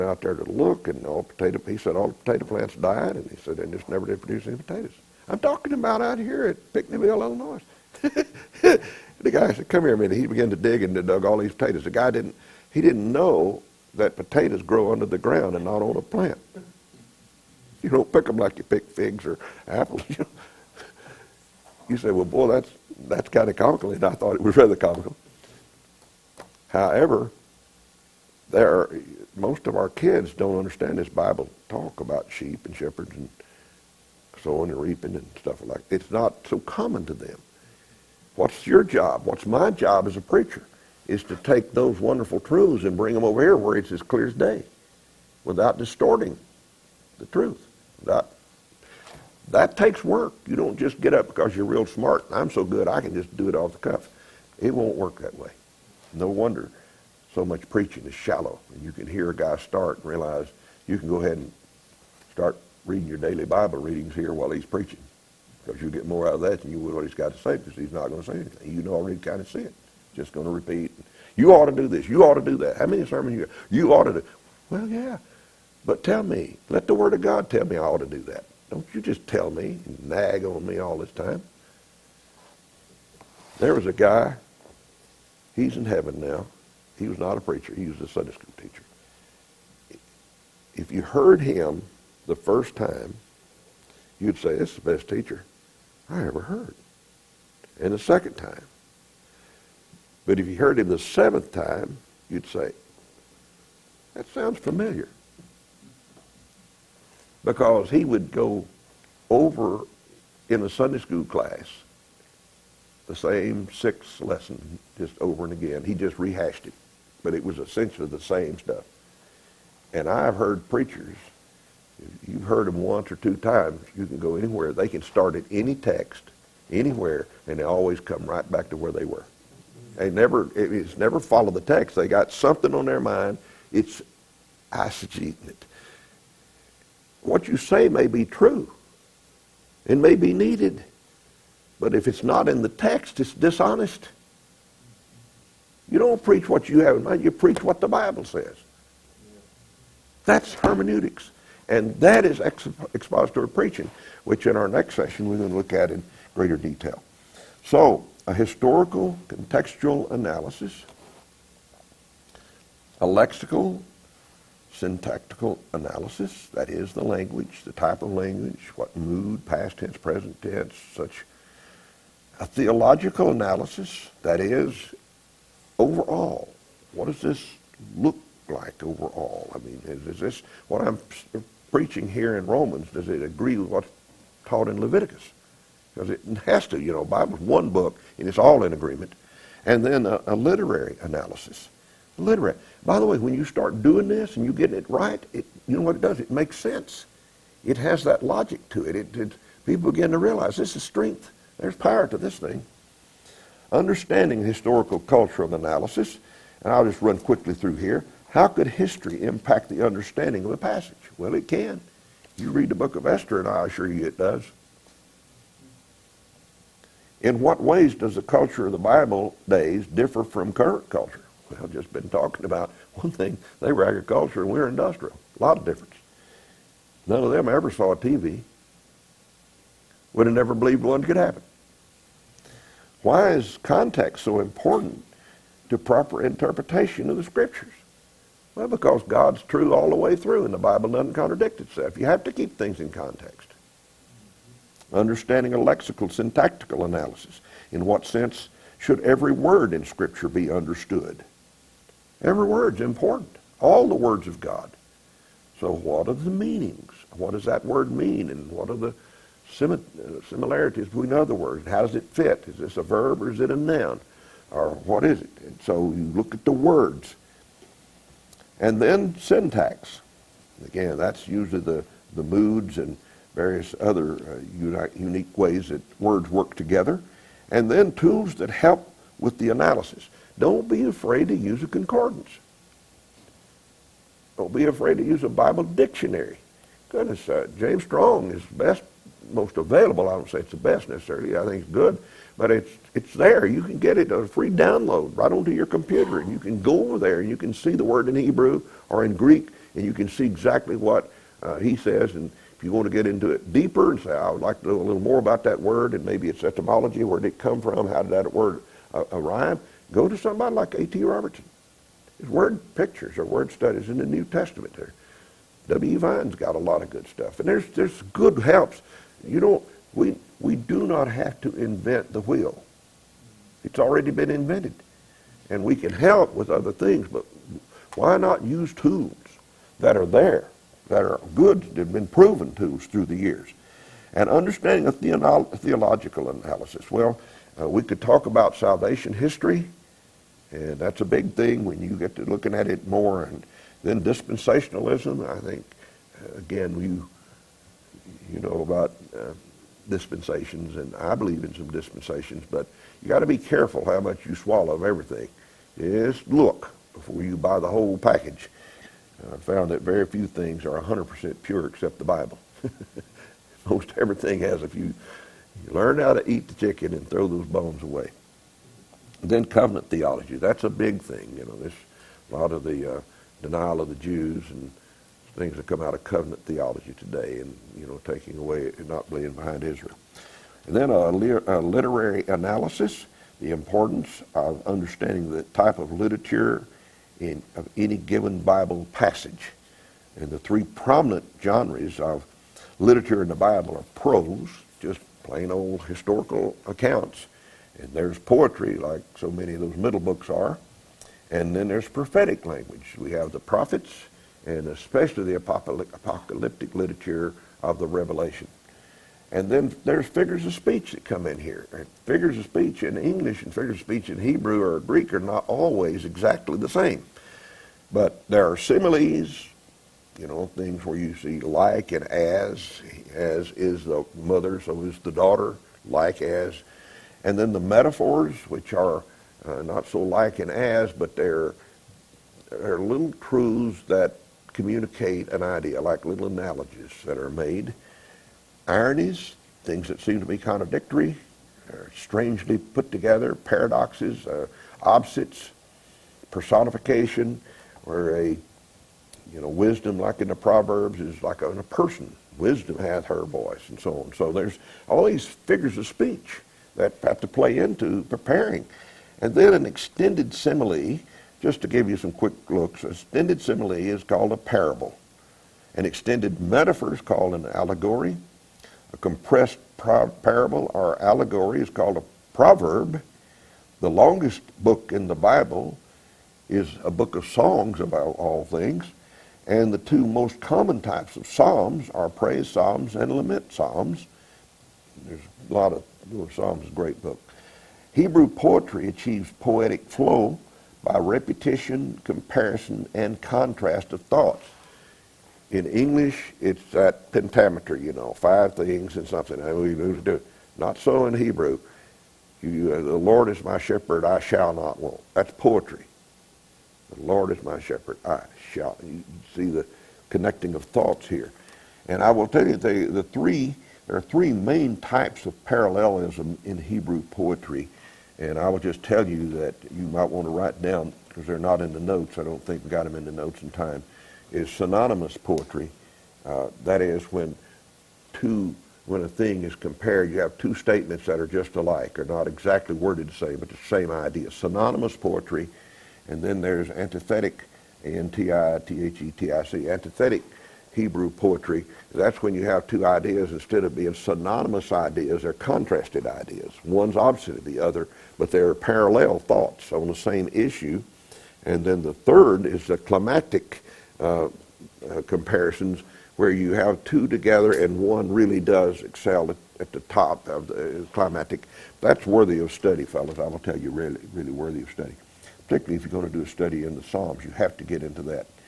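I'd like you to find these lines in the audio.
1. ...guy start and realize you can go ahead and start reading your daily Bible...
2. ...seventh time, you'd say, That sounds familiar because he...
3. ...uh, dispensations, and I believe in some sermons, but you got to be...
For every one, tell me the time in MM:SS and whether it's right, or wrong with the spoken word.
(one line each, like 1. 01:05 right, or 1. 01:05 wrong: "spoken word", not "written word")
1. 00:59 right
2. 01:40 right
3. 05:49 wrong: "dispensations", not "sermons".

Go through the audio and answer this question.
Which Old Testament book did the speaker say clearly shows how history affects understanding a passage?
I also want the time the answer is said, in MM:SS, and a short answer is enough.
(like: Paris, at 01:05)
Esther, at 03:33.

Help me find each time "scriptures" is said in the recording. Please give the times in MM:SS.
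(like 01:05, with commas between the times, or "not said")
03:57, 04:09.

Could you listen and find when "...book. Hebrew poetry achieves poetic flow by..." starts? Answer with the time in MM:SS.
08:07.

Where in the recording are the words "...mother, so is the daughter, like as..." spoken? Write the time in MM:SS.
07:04.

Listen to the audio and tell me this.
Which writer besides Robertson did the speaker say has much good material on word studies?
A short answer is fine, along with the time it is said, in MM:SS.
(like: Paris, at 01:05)
W. Vine, at 05:15.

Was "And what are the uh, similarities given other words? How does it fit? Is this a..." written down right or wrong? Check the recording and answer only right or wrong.
wrong.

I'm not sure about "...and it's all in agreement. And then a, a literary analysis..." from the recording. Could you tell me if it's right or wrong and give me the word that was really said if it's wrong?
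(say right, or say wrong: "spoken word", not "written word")
right.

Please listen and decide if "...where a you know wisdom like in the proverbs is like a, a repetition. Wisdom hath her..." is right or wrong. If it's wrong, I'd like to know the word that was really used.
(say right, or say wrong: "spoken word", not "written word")
wrong: "person", not "repetition".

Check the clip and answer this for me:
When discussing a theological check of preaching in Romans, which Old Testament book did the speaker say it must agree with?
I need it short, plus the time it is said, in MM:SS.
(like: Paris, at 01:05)
Leviticus, at 03:04.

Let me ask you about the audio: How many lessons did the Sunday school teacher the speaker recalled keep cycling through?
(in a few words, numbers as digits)
6.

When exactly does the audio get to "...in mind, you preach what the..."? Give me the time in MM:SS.
02:26.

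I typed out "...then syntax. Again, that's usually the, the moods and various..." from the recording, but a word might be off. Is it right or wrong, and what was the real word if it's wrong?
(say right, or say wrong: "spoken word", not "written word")
right.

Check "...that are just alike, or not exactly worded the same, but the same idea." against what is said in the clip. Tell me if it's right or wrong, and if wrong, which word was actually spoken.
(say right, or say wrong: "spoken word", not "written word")
right.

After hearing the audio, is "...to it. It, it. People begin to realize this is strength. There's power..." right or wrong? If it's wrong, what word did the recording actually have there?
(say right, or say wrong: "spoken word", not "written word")
right.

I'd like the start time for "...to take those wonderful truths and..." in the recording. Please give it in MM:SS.
00:41.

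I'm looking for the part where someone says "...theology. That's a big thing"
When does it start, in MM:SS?
06:09.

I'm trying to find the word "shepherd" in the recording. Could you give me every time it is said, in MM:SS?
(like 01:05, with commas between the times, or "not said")
00:32, 08:23, 08:27.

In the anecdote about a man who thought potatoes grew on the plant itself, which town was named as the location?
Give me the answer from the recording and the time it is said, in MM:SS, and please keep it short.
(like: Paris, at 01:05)
Pinckneyville, Illinois, at 00:06.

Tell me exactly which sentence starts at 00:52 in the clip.
I'm so good, I can just do it off the cuff.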